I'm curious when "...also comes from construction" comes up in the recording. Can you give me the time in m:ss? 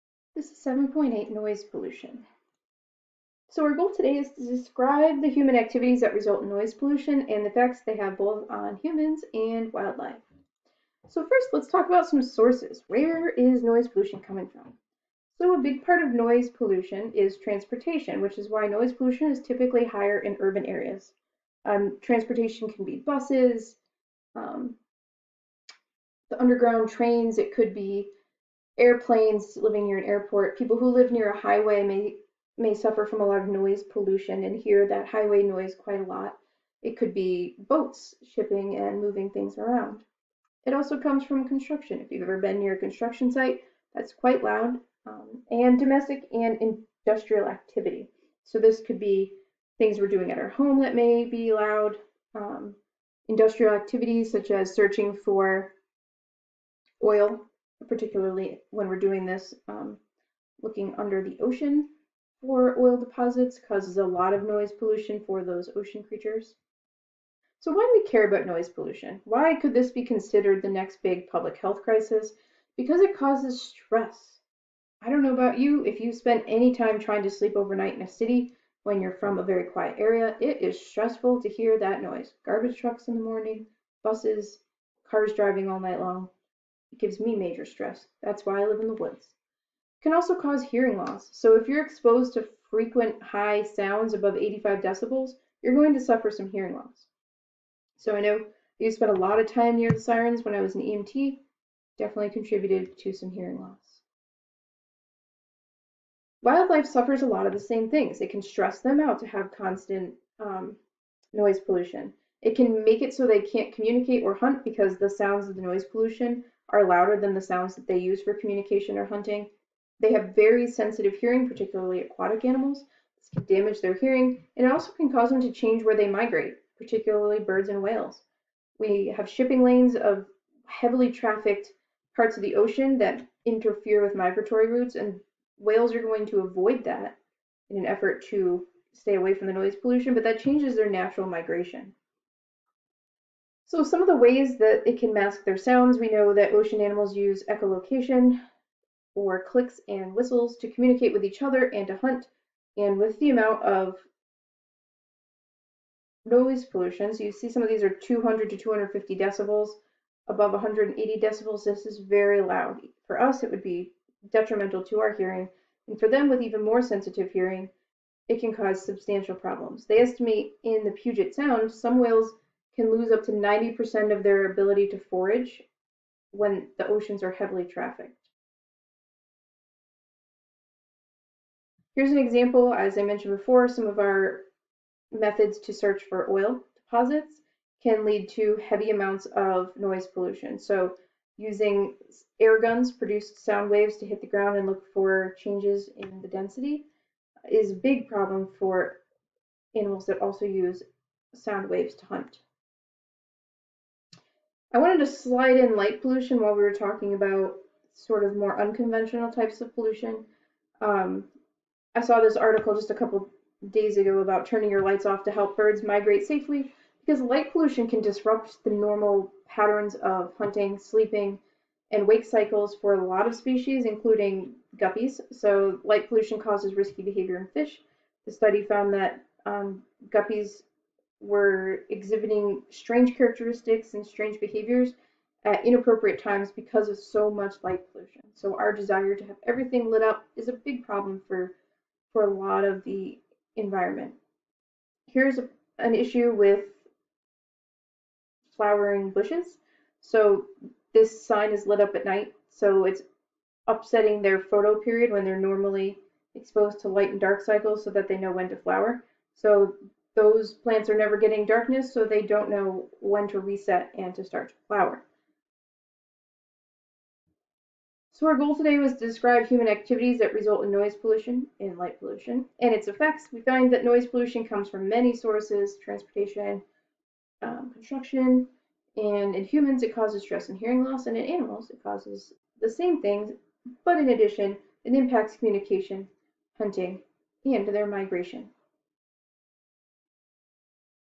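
0:40.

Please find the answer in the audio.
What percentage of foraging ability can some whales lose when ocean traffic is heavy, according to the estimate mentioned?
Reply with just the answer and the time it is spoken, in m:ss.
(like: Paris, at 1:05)
90%, at 2:53.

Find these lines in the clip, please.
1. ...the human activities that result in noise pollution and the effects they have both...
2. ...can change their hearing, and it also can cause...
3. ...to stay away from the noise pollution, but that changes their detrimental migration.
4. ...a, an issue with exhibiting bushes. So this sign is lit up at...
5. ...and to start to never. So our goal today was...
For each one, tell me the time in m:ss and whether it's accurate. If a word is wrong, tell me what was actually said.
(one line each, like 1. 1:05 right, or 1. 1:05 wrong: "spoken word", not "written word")
1. 0:05 right
2. 2:03 wrong: "damage", not "change"
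3. 2:18 wrong: "natural", not "detrimental"
4. 4:05 wrong: "flowering", not "exhibiting"
5. 4:23 wrong: "flower", not "never".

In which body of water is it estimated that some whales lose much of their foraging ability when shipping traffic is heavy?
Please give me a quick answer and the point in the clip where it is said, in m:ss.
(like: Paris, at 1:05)
Puget Sound, at 2:50.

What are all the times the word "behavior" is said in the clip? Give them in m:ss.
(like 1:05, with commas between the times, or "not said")
3:47, 3:54.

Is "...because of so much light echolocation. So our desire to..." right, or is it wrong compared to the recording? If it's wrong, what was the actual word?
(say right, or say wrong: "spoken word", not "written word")
wrong: "pollution", not "echolocation".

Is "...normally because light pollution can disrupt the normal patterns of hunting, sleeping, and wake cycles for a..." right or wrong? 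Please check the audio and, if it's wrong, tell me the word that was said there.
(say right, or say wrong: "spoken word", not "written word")
wrong: "safely", not "normally".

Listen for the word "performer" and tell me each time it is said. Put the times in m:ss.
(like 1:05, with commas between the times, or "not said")
not said.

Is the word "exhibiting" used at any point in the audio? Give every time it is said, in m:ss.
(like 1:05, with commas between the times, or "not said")
3:51.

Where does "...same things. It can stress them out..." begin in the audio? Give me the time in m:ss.
1:47.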